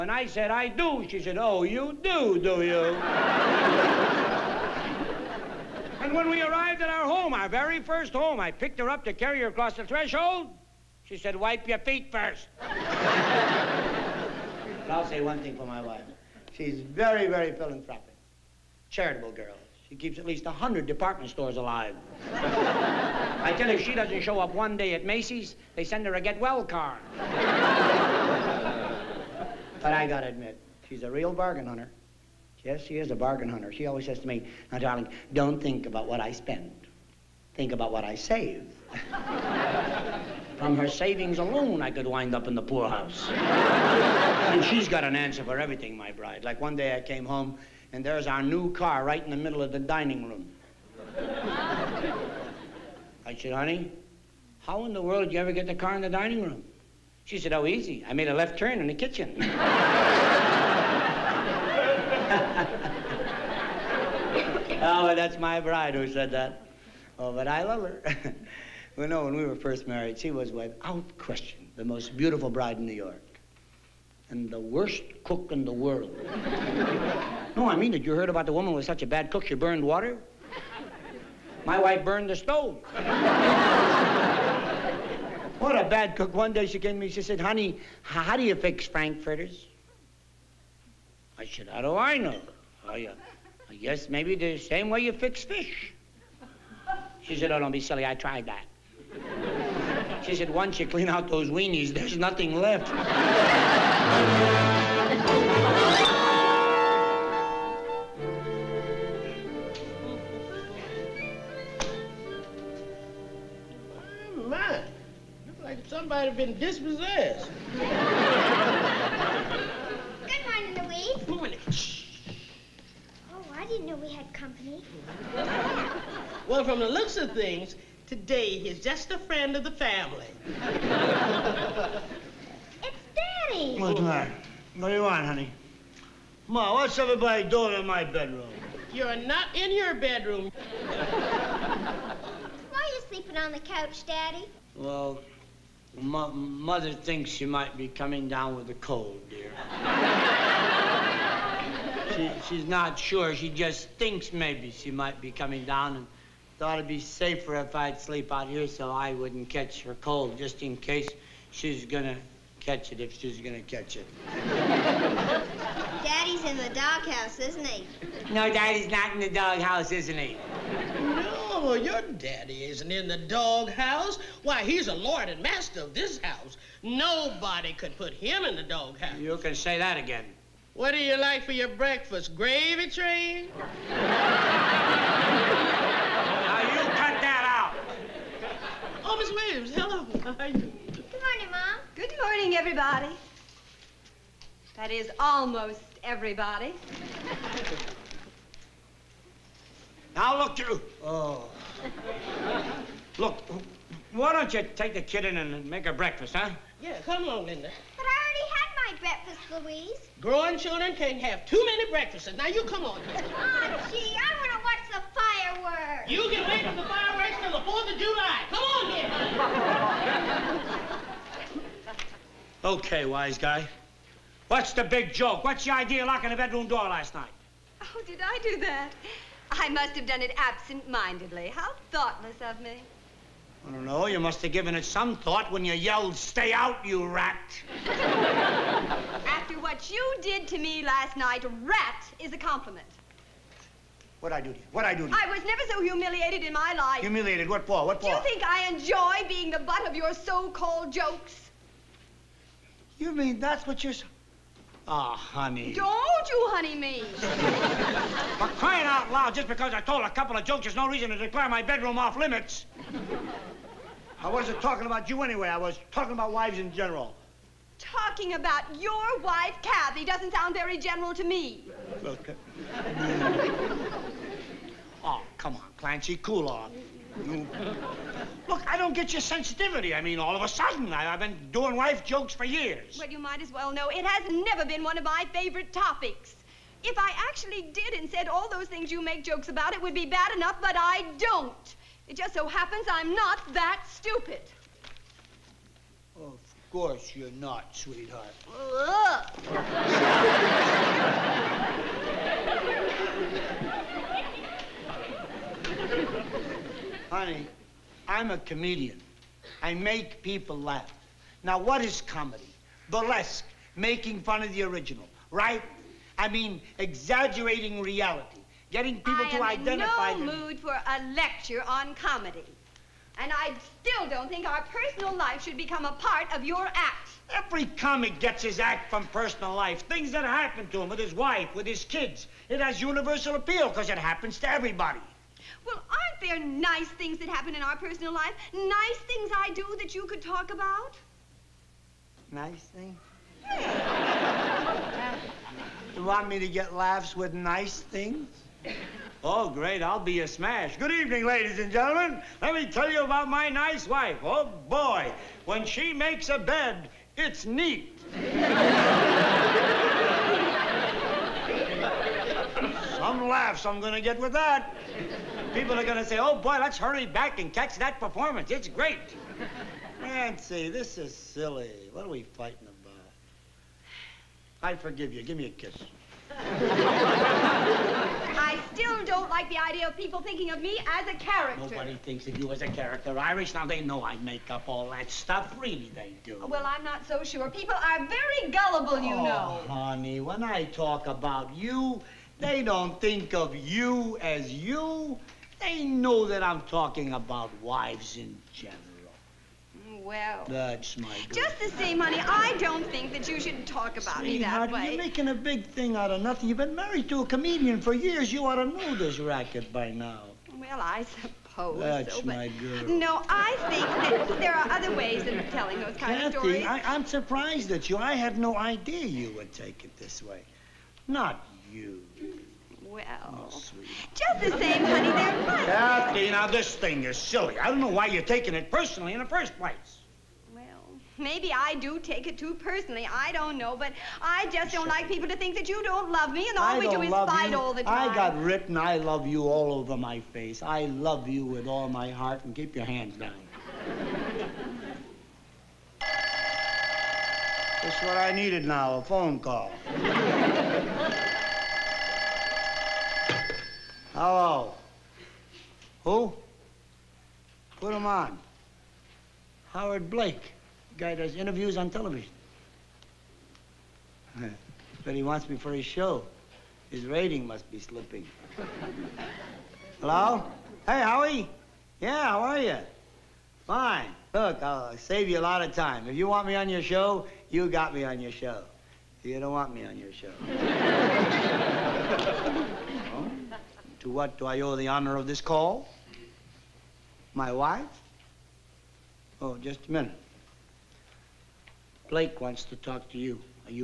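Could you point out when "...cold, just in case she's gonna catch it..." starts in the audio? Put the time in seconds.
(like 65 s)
160 s.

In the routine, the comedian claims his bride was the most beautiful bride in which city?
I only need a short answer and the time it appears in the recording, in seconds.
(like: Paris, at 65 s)
New York, at 72 s.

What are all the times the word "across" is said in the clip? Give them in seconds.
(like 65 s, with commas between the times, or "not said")
9 s.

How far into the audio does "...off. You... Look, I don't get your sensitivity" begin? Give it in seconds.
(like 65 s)
276 s.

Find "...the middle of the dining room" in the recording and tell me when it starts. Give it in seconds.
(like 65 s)
49 s.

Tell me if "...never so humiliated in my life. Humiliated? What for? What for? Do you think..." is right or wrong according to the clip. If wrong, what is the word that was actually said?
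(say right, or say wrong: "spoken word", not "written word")
right.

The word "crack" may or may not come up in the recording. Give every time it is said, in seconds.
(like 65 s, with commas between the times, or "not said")
not said.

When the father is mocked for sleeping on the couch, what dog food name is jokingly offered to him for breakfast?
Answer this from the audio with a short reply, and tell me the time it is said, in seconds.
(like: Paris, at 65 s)
Gravy Train, at 182 s.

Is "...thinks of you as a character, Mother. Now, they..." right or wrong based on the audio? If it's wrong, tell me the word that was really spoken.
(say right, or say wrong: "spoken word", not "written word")
wrong: "Irish", not "Mother".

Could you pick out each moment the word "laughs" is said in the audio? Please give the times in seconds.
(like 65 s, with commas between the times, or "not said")
310 s, 346 s, 363 s.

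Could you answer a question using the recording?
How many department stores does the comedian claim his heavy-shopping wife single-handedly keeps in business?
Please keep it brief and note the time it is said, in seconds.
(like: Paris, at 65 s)
100, at 20 s.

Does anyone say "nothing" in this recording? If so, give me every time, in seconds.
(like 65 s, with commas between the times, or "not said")
102 s, 406 s.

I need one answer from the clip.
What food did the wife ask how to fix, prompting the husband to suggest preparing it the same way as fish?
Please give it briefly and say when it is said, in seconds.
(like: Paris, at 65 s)
Frankfurters, at 88 s.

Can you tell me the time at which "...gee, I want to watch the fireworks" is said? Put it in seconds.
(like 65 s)
213 s.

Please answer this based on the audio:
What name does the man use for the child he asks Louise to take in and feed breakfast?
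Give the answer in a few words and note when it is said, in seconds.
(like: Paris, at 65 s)
Linda, at 207 s.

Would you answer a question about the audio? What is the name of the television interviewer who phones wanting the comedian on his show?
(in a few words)
Howard Blake.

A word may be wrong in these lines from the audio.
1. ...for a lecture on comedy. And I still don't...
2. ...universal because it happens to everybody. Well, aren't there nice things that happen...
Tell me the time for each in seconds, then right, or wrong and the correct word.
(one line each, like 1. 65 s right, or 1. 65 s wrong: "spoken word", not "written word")
1. 320 s right
2. 333 s wrong: "appeal", not "universal".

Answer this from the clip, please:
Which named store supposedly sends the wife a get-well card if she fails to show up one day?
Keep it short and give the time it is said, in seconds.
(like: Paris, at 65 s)
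Macy's, at 25 s.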